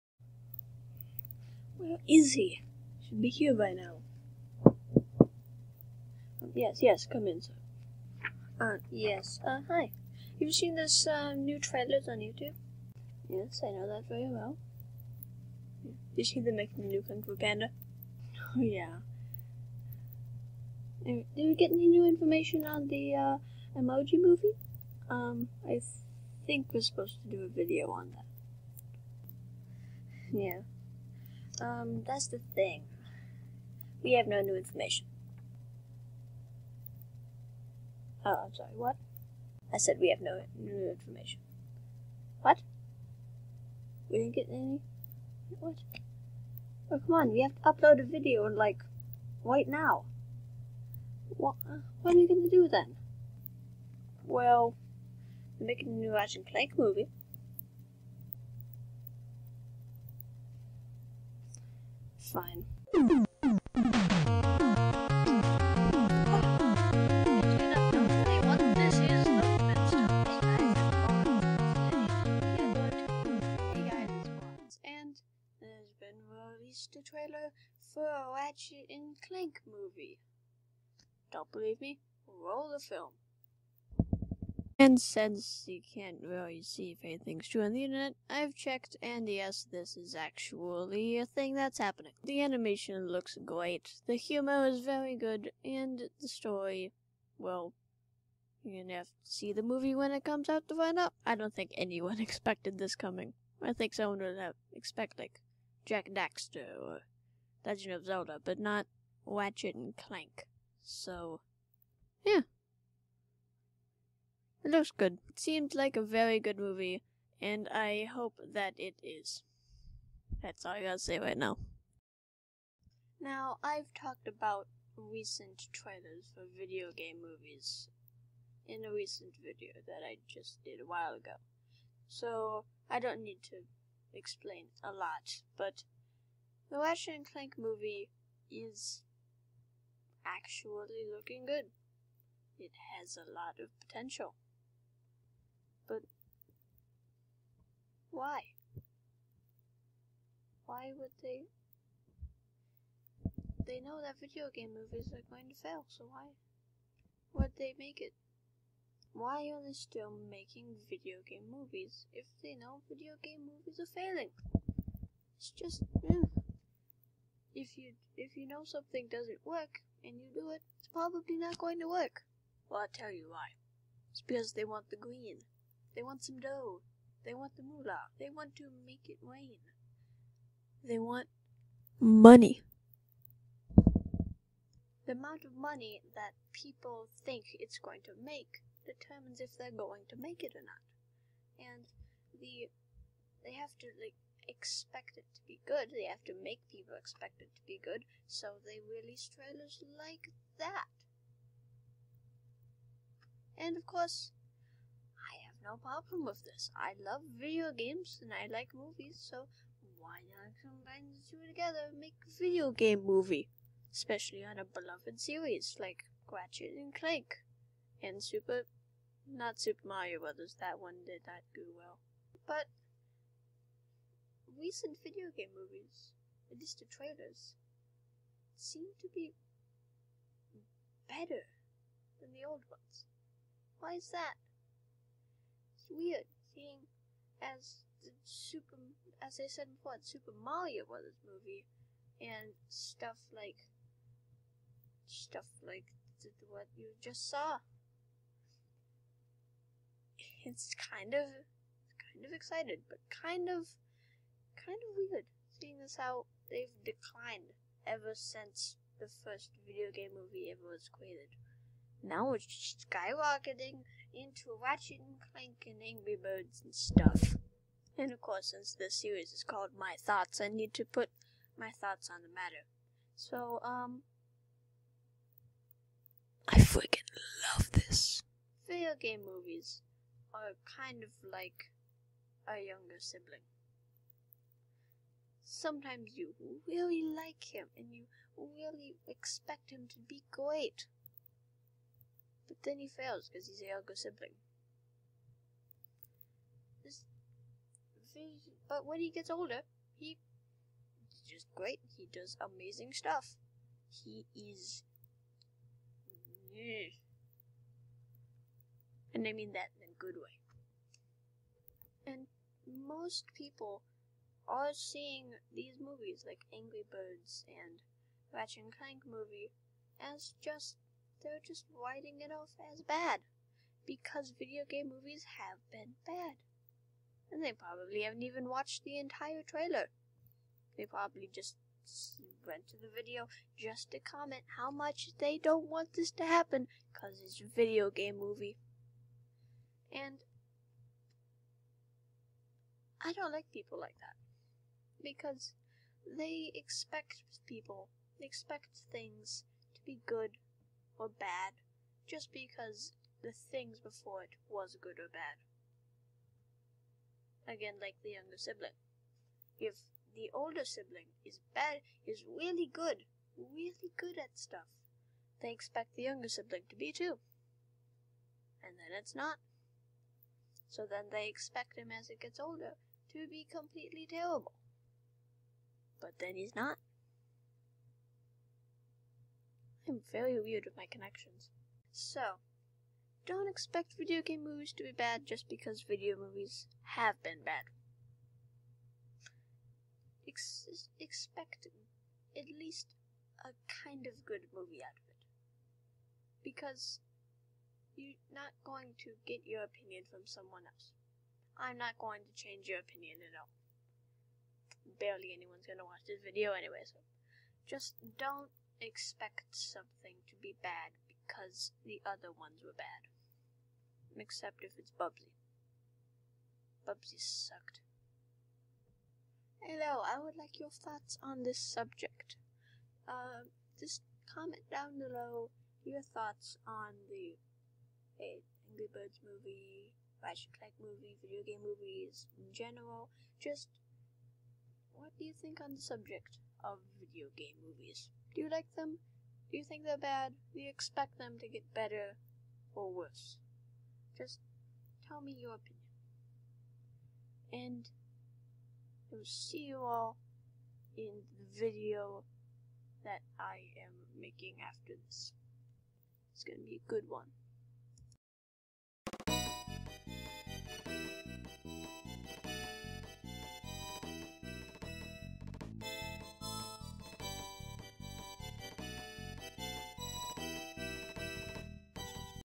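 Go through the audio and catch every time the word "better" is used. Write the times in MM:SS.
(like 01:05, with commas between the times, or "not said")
03:51, 07:21.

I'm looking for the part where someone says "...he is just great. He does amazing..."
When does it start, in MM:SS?
04:59.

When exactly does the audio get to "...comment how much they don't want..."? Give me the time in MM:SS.
05:33.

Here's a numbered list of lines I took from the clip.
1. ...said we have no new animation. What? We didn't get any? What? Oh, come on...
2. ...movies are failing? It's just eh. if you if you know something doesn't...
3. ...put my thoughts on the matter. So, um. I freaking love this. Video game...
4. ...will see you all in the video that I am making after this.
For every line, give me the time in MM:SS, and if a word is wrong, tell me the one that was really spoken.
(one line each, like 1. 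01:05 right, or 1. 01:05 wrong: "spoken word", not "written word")
1. 00:39 wrong: "information", not "animation"
2. 02:43 right
3. 04:30 right
4. 07:29 right.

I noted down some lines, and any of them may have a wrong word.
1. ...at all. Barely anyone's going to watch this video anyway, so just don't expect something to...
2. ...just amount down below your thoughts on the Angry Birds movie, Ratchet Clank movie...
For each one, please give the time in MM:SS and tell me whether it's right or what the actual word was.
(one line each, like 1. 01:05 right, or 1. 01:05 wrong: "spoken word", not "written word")
1. 06:43 right
2. 07:03 wrong: "comment", not "amount".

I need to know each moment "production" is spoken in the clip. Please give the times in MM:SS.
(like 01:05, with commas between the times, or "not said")
not said.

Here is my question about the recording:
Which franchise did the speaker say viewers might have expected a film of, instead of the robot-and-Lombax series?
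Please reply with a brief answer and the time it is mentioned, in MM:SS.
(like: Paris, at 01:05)
Jack Daxter, at 01:45.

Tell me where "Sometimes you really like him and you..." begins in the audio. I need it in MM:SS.
04:45.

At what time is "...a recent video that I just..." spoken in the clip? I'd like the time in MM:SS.
02:08.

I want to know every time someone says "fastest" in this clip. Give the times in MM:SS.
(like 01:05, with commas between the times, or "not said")
not said.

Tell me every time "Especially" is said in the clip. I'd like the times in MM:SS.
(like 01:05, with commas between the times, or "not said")
03:33.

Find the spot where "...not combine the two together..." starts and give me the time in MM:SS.
03:30.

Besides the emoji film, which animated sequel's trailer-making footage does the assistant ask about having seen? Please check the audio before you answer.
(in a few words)
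Kung Fu Panda.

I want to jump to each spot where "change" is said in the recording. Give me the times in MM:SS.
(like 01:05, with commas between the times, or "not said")
06:42.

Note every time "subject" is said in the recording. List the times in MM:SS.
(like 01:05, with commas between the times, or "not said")
07:01, 07:15.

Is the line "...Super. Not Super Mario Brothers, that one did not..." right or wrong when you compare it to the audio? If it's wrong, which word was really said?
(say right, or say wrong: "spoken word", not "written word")
right.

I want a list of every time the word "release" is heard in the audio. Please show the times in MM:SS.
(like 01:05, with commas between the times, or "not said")
03:18.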